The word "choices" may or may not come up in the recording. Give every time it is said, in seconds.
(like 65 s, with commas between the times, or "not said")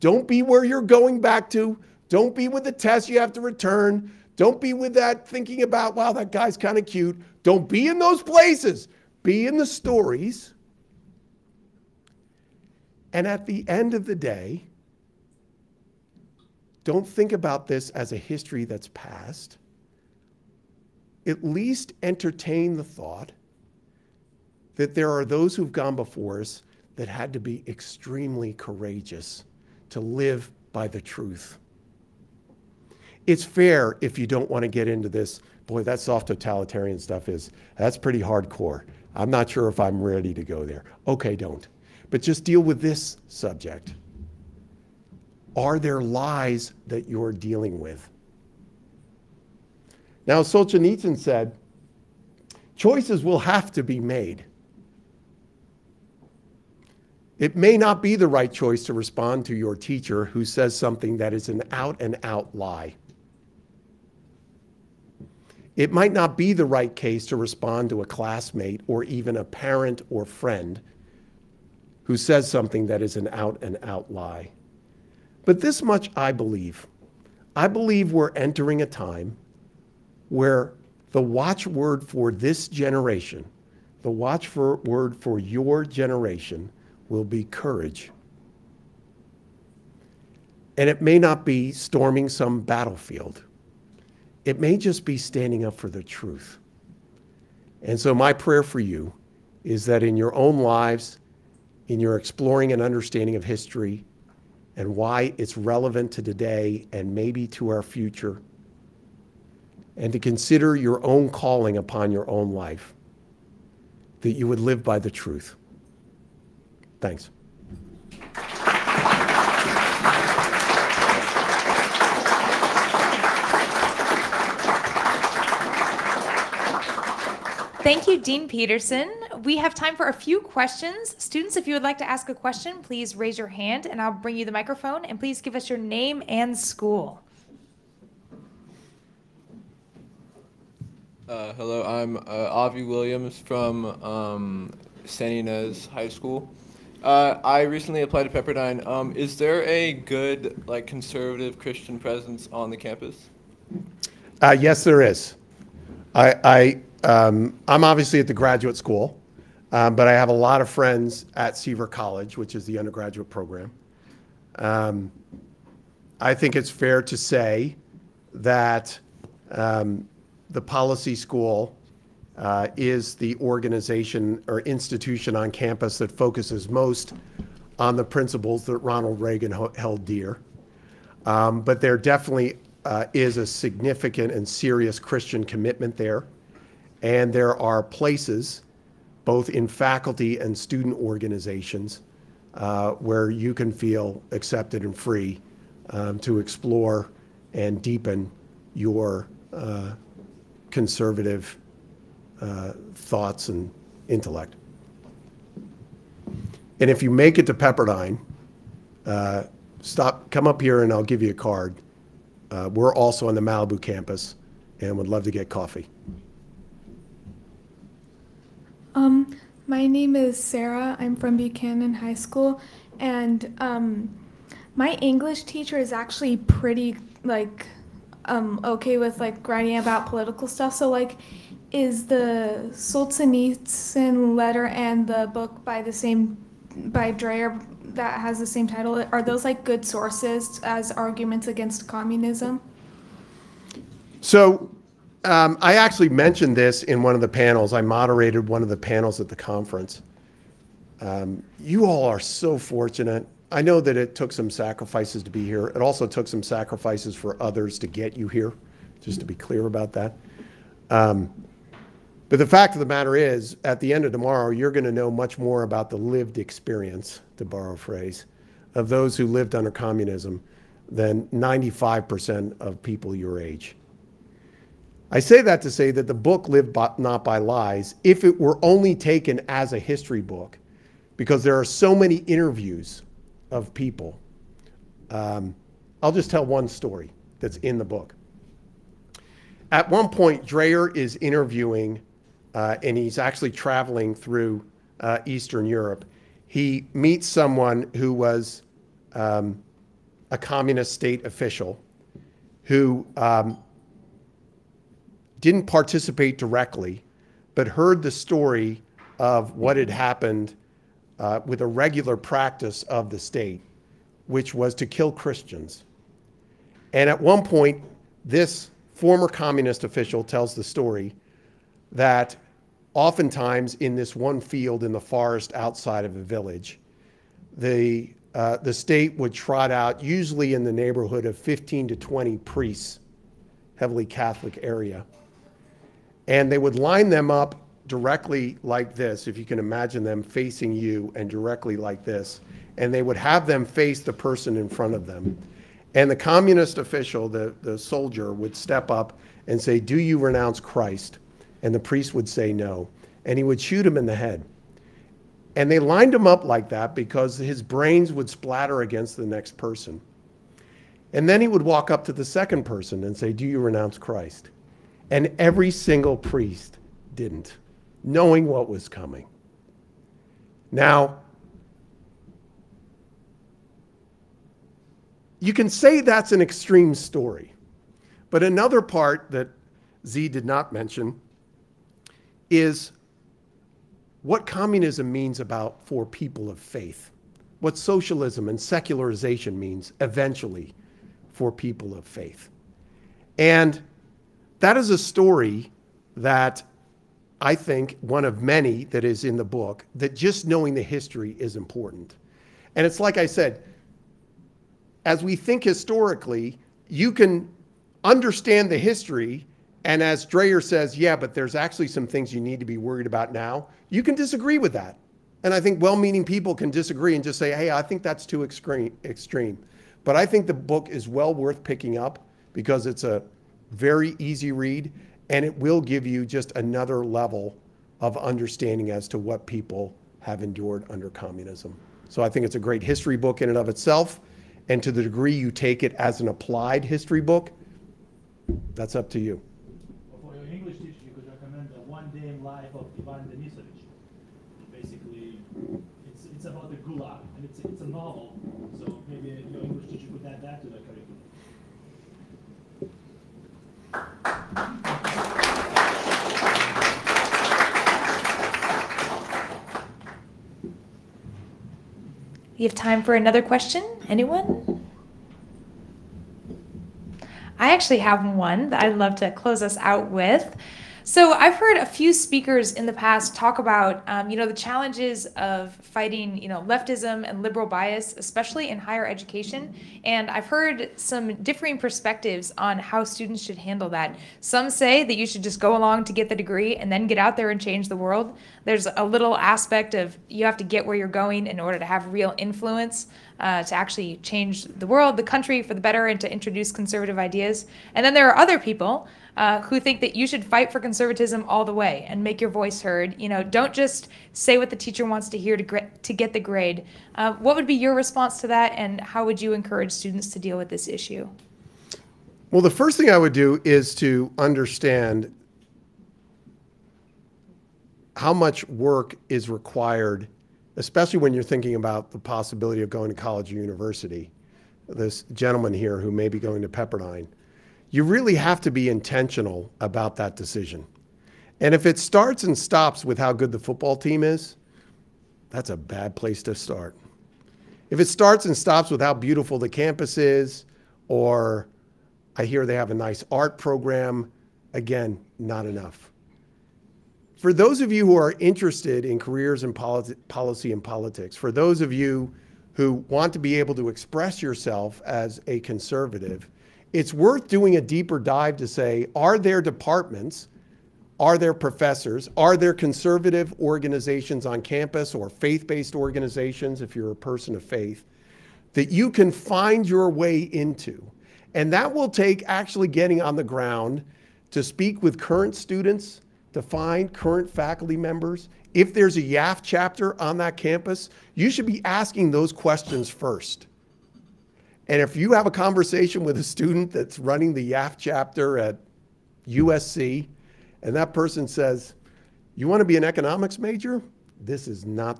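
52 s, 58 s.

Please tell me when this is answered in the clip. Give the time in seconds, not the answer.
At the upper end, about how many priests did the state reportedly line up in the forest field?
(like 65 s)
331 s.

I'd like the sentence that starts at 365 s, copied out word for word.
And every single priest didn't, knowing what was coming.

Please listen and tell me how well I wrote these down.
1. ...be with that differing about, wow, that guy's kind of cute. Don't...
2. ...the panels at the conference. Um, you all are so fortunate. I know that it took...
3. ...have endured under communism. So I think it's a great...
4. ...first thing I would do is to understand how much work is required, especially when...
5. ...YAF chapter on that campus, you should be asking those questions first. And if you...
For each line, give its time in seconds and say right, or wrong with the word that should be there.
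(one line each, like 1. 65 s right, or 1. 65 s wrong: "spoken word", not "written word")
1. 4 s wrong: "thinking", not "differing"
2. 248 s right
3. 430 s right
4. 512 s right
5. 579 s right.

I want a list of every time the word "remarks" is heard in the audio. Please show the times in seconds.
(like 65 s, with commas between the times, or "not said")
not said.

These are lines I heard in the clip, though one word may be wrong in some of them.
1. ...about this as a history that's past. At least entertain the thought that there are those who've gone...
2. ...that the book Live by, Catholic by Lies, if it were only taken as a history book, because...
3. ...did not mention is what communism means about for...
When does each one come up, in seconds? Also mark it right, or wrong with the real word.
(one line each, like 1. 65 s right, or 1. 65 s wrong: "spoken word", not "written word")
1. 17 s right
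2. 275 s wrong: "Not", not "Catholic"
3. 380 s right.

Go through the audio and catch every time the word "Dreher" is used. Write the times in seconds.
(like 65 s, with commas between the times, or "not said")
237 s, 290 s, 410 s.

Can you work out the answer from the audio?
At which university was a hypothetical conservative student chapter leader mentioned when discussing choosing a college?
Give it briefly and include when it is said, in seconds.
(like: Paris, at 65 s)
USC, at 589 s.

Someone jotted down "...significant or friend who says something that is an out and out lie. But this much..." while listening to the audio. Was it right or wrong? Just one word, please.
wrong.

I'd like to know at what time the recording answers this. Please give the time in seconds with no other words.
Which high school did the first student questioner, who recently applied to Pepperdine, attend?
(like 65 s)
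145 s.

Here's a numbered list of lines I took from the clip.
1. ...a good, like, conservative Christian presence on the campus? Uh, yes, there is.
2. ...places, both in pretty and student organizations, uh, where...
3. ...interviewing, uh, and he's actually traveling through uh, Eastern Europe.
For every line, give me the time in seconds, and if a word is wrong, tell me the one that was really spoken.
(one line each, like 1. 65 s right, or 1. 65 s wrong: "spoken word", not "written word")
1. 149 s right
2. 187 s wrong: "faculty", not "pretty"
3. 291 s right.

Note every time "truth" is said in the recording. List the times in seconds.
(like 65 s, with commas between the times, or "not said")
31 s, 96 s, 115 s.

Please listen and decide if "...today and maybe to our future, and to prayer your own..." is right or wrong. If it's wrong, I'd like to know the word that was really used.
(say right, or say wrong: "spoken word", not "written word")
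wrong: "consider", not "prayer".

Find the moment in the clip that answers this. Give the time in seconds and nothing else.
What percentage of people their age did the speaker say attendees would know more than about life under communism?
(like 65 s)
271 s.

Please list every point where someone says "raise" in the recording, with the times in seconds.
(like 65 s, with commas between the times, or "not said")
133 s.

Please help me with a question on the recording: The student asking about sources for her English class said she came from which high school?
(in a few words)
Buchanan High School.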